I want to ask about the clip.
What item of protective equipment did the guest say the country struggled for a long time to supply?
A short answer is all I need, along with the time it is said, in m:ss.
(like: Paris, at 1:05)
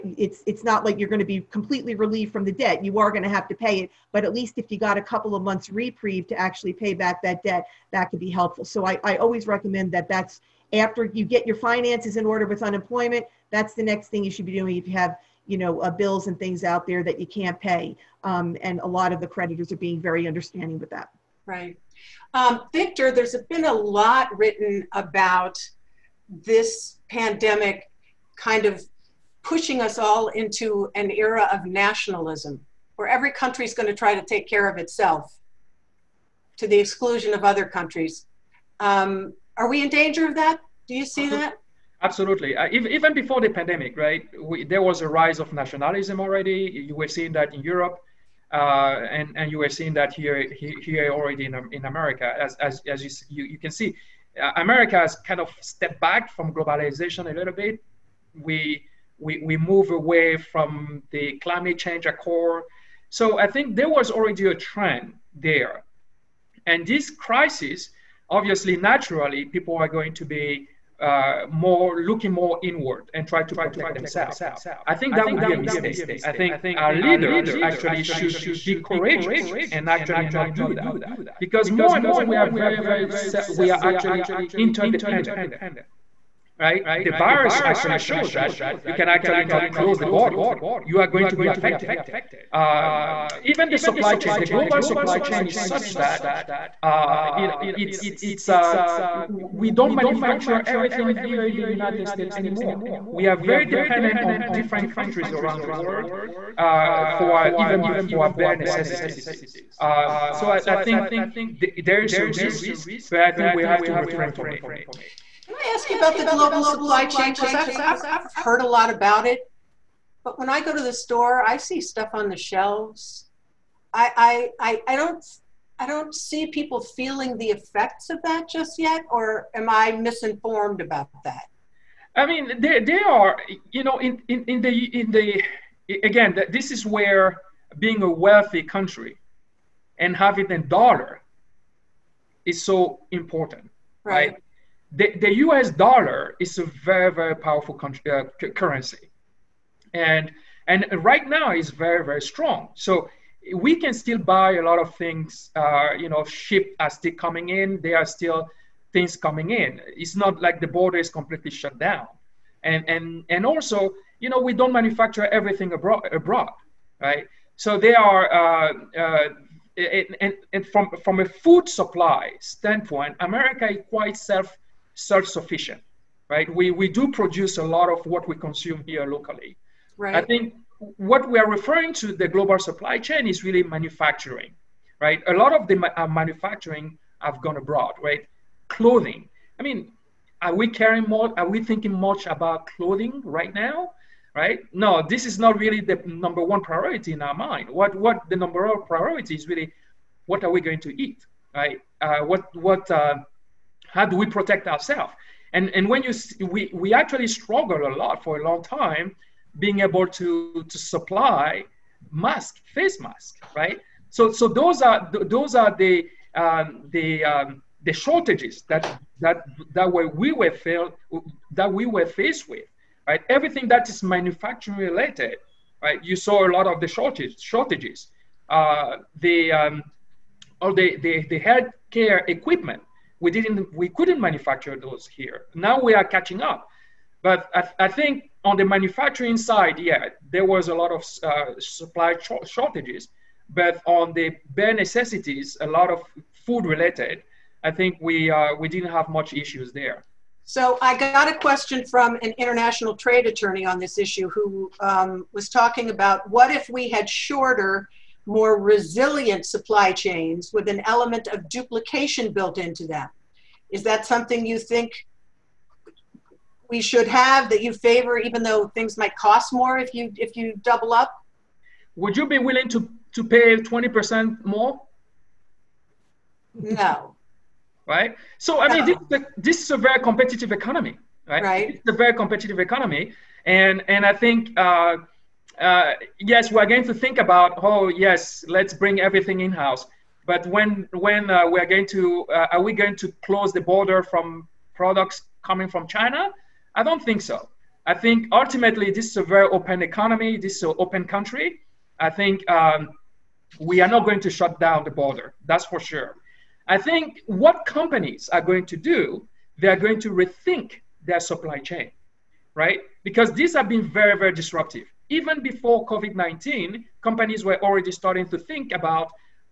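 face mask, at 3:32.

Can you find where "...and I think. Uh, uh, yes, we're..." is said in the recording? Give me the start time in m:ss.
4:43.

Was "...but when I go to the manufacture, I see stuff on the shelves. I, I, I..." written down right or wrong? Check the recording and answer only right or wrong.
wrong.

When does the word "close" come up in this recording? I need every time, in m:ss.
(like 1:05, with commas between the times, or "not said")
1:29, 4:53.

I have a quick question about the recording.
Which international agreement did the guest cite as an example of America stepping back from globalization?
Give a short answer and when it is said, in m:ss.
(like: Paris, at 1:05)
climate change accord, at 1:01.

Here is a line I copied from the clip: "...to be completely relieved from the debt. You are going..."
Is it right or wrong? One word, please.
right.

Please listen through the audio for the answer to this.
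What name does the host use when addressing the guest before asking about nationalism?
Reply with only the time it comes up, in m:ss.
0:22.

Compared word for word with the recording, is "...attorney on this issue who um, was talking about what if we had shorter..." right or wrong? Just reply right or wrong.
right.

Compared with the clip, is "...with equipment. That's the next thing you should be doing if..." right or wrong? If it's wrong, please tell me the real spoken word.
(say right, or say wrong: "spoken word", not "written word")
wrong: "unemployment", not "equipment".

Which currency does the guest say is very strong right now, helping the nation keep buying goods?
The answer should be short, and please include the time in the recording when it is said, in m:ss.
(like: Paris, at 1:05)
US dollar, at 2:25.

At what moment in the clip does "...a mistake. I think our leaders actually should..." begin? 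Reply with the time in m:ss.
1:15.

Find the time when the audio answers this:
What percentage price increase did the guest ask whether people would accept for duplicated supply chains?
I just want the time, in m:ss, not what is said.
4:33.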